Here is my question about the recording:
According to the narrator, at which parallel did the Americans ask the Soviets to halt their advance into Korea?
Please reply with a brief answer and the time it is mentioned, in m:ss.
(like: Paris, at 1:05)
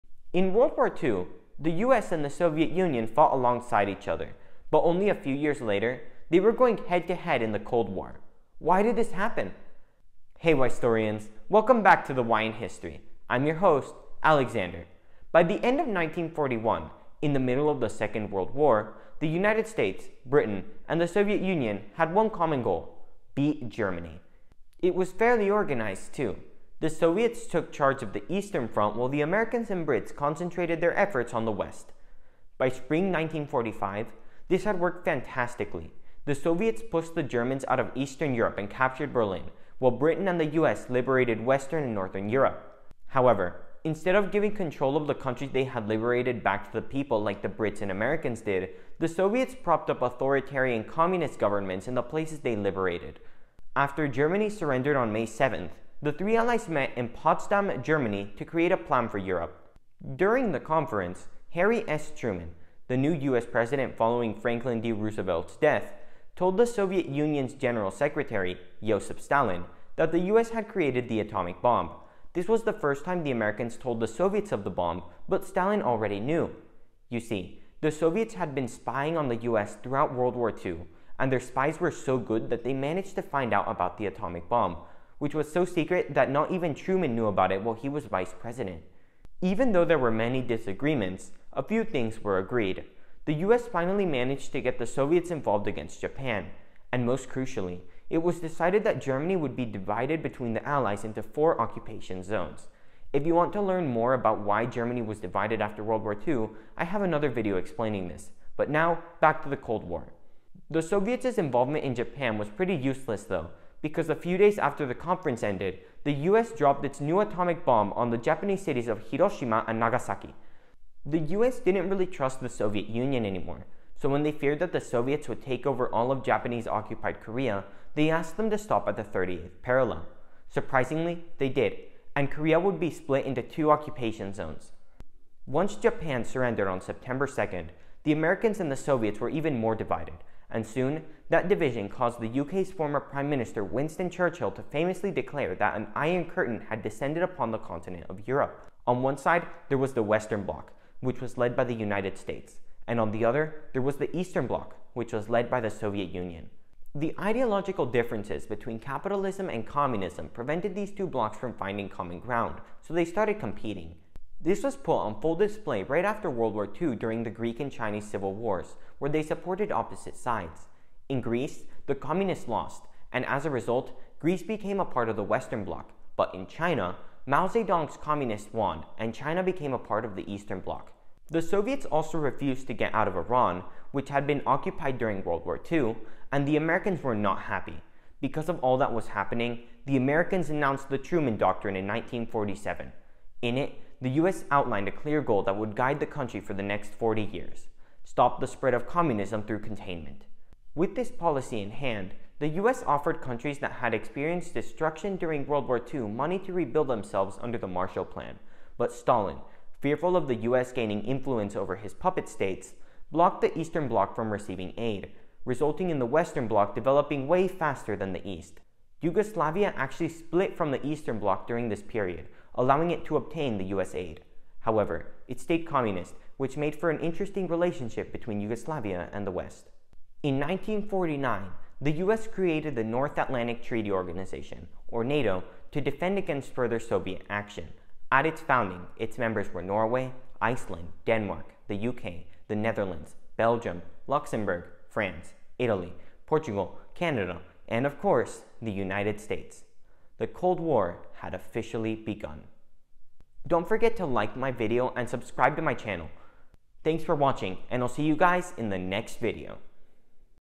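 30th parallel, at 2:09.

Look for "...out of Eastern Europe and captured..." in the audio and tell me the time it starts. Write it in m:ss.
0:37.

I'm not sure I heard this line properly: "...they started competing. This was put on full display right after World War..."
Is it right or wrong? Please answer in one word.
right.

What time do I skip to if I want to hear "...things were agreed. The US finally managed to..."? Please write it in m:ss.
1:31.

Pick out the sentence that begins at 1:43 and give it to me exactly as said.
If you want to learn more about why Germany was divided after World War II, I have another video explaining this.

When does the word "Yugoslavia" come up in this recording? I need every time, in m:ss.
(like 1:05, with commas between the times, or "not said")
3:38, 3:48.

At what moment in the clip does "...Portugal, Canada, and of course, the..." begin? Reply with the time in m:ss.
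4:06.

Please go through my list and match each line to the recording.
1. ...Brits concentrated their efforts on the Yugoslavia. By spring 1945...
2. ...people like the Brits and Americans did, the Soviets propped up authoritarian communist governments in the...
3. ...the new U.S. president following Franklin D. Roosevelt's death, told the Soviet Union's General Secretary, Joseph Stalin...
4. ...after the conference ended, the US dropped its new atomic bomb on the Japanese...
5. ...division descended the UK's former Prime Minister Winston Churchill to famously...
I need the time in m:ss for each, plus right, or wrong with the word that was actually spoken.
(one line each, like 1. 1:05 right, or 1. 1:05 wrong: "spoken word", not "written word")
1. 0:29 wrong: "West", not "Yugoslavia"
2. 0:46 right
3. 1:02 right
4. 1:54 right
5. 2:21 wrong: "caused", not "descended".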